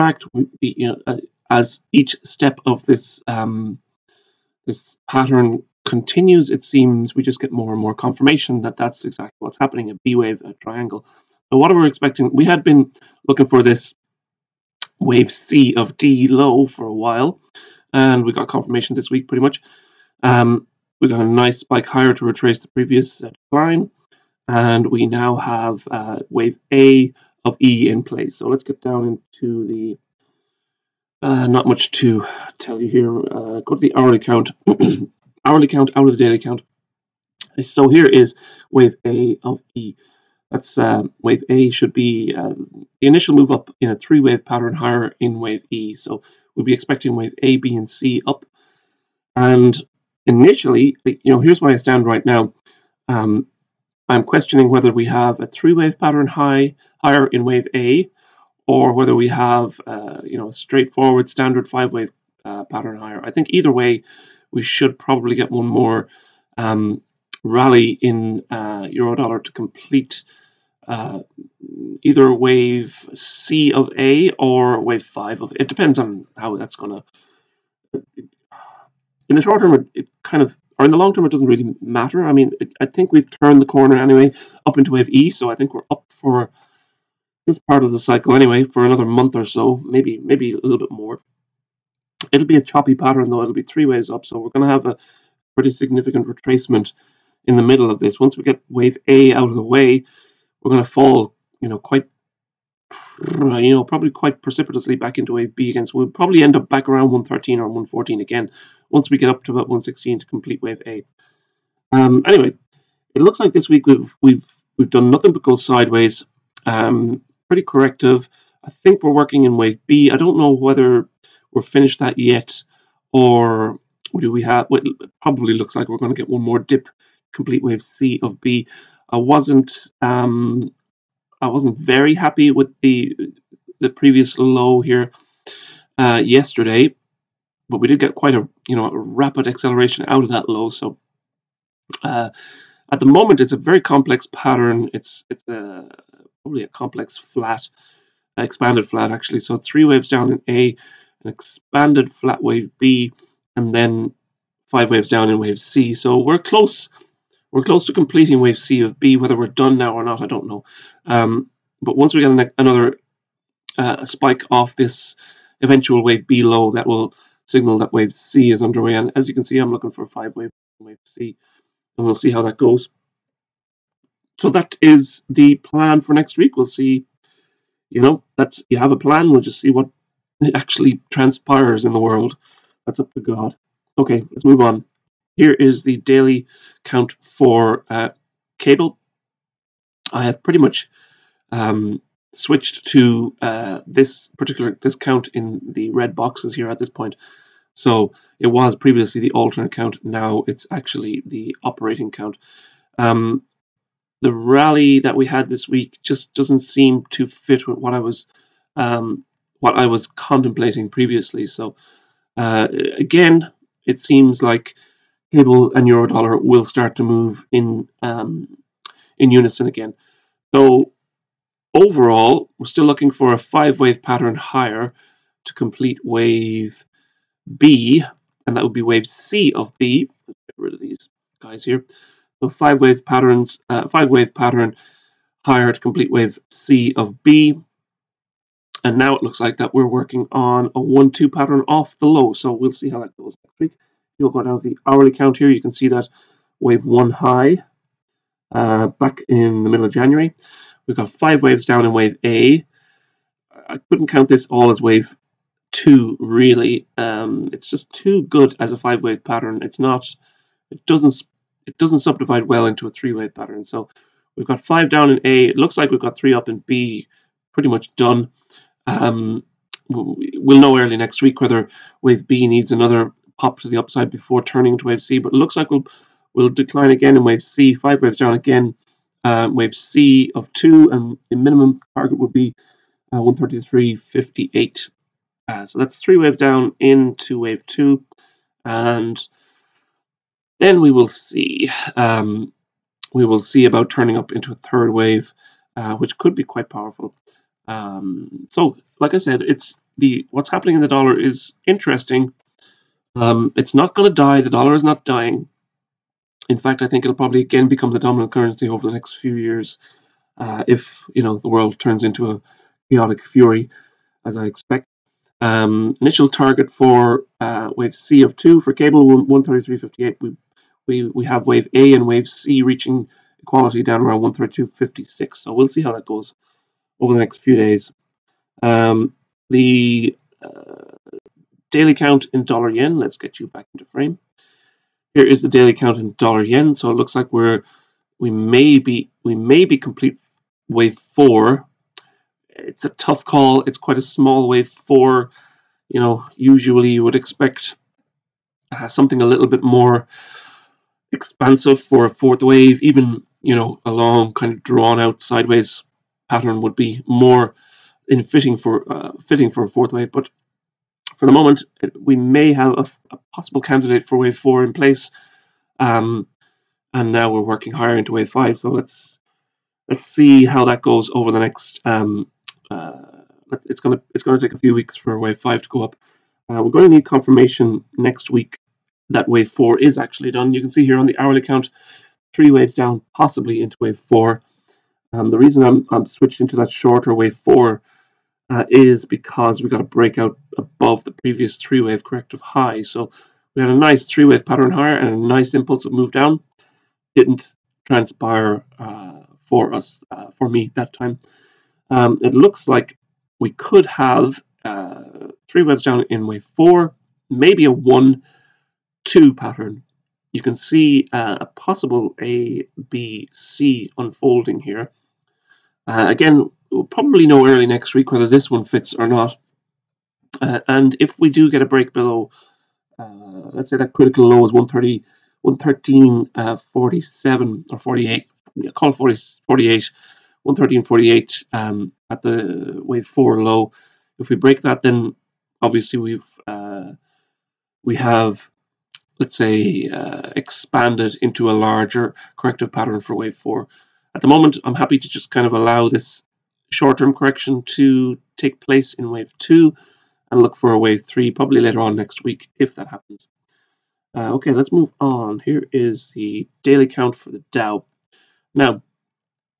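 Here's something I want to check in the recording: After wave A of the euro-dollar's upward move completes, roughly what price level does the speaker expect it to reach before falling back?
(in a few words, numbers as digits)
116.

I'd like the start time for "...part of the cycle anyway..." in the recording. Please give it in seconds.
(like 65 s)
87 s.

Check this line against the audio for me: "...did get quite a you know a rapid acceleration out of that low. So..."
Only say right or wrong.
right.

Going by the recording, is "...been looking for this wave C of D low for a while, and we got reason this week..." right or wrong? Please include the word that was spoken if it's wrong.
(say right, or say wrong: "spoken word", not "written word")
wrong: "confirmation", not "reason".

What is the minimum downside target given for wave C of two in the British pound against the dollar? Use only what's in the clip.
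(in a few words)
133.58.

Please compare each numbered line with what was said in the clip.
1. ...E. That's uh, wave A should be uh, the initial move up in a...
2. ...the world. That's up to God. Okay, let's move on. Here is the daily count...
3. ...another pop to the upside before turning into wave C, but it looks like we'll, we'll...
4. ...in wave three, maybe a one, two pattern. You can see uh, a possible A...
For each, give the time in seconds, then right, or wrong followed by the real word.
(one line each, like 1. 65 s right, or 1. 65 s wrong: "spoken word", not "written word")
1. 39 s right
2. 181 s right
3. 272 s right
4. 406 s wrong: "four", not "three".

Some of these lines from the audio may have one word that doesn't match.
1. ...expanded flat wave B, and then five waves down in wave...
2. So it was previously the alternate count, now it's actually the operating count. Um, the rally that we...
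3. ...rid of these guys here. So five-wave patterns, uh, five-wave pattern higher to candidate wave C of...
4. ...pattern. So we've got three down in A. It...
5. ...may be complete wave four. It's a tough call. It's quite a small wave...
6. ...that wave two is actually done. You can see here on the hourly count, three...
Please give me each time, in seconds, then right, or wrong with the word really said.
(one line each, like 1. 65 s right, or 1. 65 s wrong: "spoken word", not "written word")
1. 151 s right
2. 197 s right
3. 230 s wrong: "complete", not "candidate"
4. 263 s wrong: "five", not "three"
5. 339 s right
6. 379 s wrong: "four", not "two".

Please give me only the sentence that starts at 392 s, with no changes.
So we had a nice three wave pattern higher and a nice impulse impulsive move down.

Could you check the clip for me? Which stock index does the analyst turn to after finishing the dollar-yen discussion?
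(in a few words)
The Dow.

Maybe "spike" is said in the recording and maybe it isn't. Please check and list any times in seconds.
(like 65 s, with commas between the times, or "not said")
21 s, 164 s.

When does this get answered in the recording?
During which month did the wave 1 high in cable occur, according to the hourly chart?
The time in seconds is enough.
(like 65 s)
249 s.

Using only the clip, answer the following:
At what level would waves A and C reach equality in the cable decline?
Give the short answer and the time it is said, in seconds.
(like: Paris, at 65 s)
132.56, at 324 s.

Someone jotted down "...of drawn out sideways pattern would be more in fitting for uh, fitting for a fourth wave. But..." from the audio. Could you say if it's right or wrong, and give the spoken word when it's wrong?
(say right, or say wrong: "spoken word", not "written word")
right.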